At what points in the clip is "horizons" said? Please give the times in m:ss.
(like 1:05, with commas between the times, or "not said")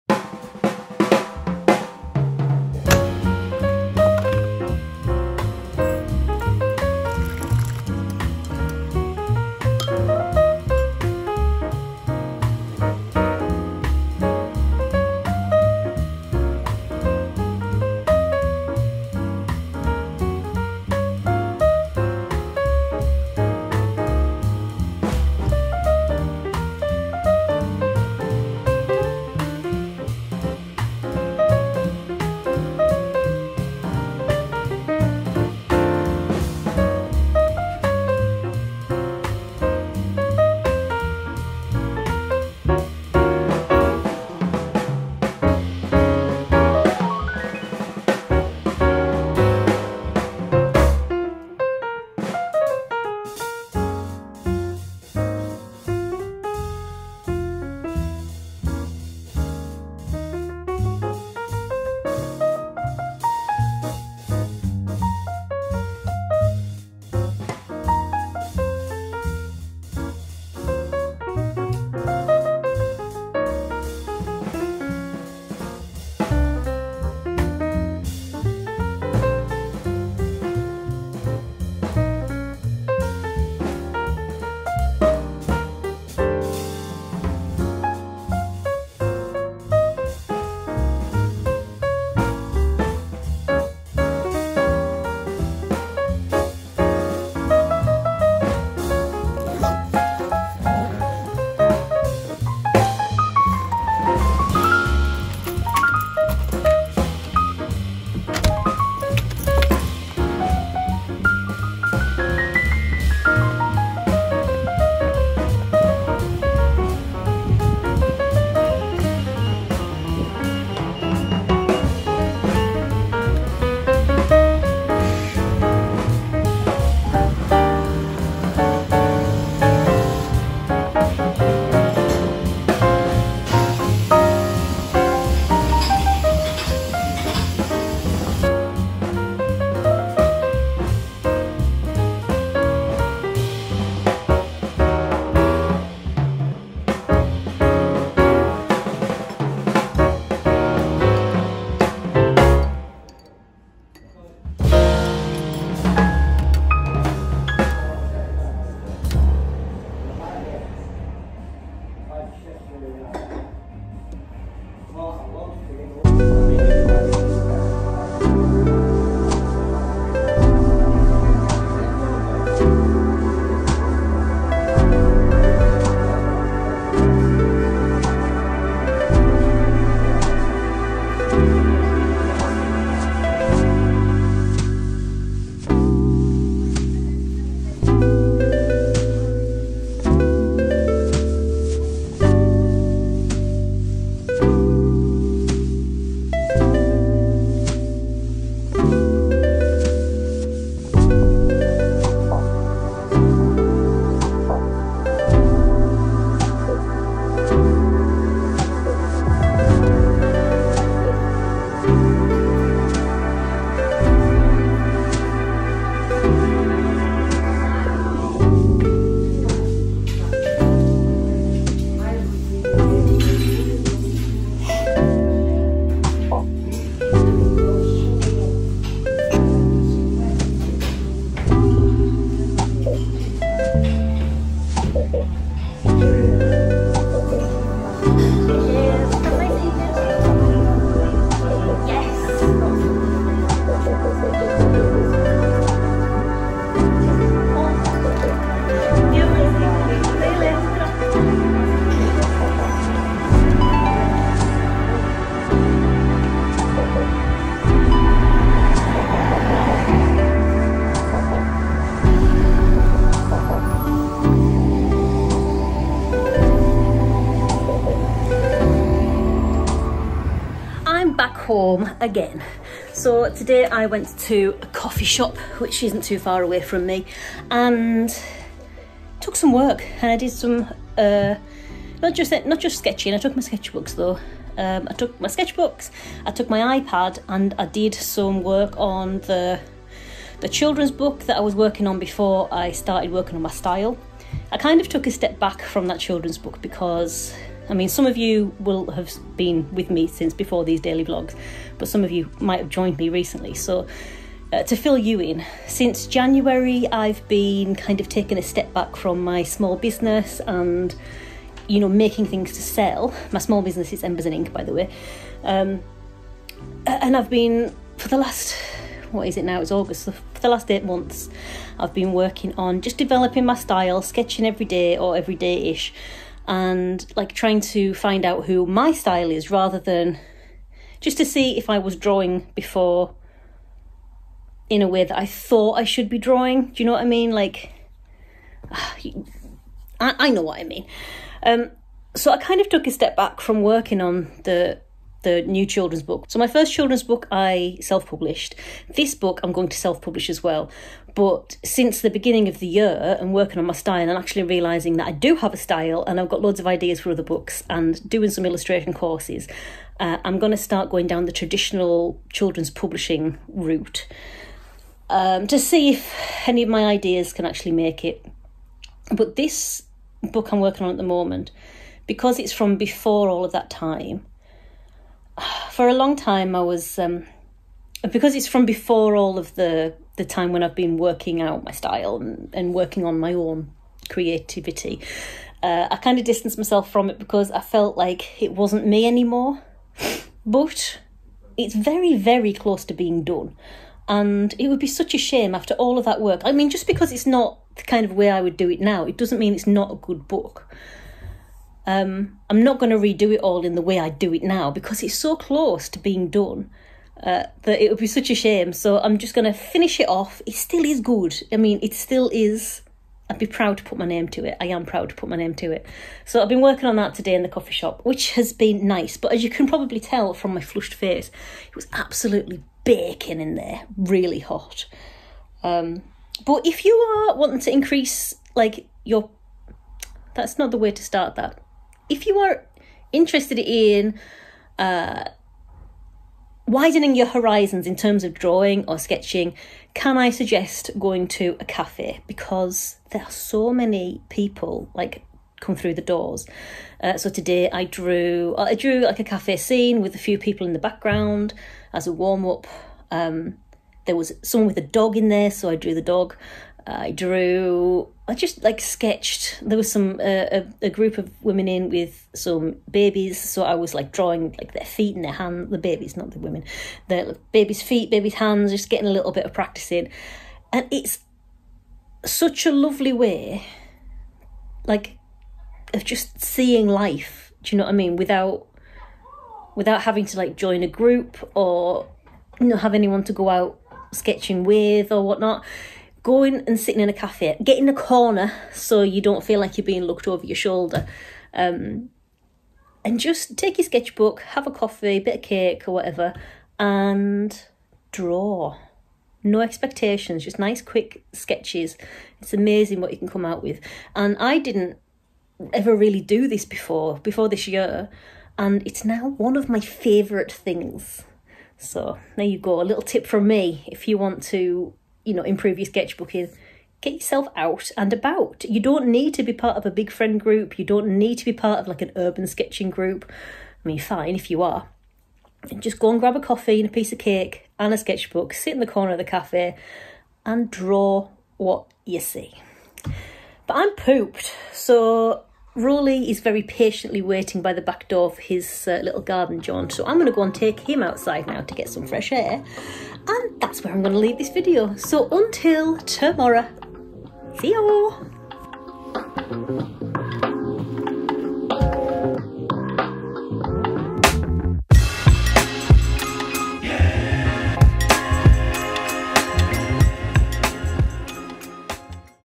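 7:17.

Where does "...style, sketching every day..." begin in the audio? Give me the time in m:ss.
5:23.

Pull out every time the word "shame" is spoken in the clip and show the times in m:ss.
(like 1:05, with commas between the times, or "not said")
6:35, 6:48.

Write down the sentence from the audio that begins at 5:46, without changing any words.
So my first children's book I self-published.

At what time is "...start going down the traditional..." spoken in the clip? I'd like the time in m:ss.
6:00.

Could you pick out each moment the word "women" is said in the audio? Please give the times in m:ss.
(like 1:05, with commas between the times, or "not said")
7:41, 7:46.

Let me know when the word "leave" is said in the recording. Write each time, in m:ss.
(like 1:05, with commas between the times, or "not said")
9:04.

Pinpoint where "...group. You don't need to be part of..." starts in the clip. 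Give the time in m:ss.
8:40.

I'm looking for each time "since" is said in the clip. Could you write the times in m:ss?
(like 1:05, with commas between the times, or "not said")
5:00, 5:05, 5:51.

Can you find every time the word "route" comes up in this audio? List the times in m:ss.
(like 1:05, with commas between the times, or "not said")
6:03.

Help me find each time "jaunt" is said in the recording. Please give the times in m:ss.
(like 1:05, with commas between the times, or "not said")
8:59.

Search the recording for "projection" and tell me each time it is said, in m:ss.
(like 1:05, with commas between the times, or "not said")
not said.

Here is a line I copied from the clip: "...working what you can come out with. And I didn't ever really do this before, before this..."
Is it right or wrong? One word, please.
wrong.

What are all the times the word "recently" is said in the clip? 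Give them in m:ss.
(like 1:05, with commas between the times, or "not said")
5:03.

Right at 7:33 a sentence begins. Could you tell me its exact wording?
Um, there was someone with a dog in there, so I drew the dog.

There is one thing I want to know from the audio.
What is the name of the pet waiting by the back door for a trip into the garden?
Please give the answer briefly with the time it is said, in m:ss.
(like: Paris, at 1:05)
Rowley, at 8:55.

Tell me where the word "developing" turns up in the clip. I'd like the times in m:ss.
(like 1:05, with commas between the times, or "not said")
5:22.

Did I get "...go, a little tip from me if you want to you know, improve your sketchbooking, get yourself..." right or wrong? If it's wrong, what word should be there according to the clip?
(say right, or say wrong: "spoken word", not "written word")
right.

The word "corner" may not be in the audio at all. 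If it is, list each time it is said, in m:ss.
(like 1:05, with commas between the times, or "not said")
8:07, 8:48.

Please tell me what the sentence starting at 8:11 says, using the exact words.
Um, and just take your sketchbook, have a coffee, bit of cake or whatever, and draw.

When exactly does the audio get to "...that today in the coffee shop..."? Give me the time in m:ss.
6:56.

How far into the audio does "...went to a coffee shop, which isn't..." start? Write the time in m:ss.
4:33.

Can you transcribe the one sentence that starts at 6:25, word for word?
Uh, I kind of distanced myself from it because I felt like it wasn't me anymore.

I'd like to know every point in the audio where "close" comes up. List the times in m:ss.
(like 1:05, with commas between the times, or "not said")
6:32, 6:45.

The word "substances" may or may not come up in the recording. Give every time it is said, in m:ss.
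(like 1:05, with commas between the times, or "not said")
not said.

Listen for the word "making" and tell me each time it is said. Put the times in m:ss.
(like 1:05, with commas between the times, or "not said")
5:11.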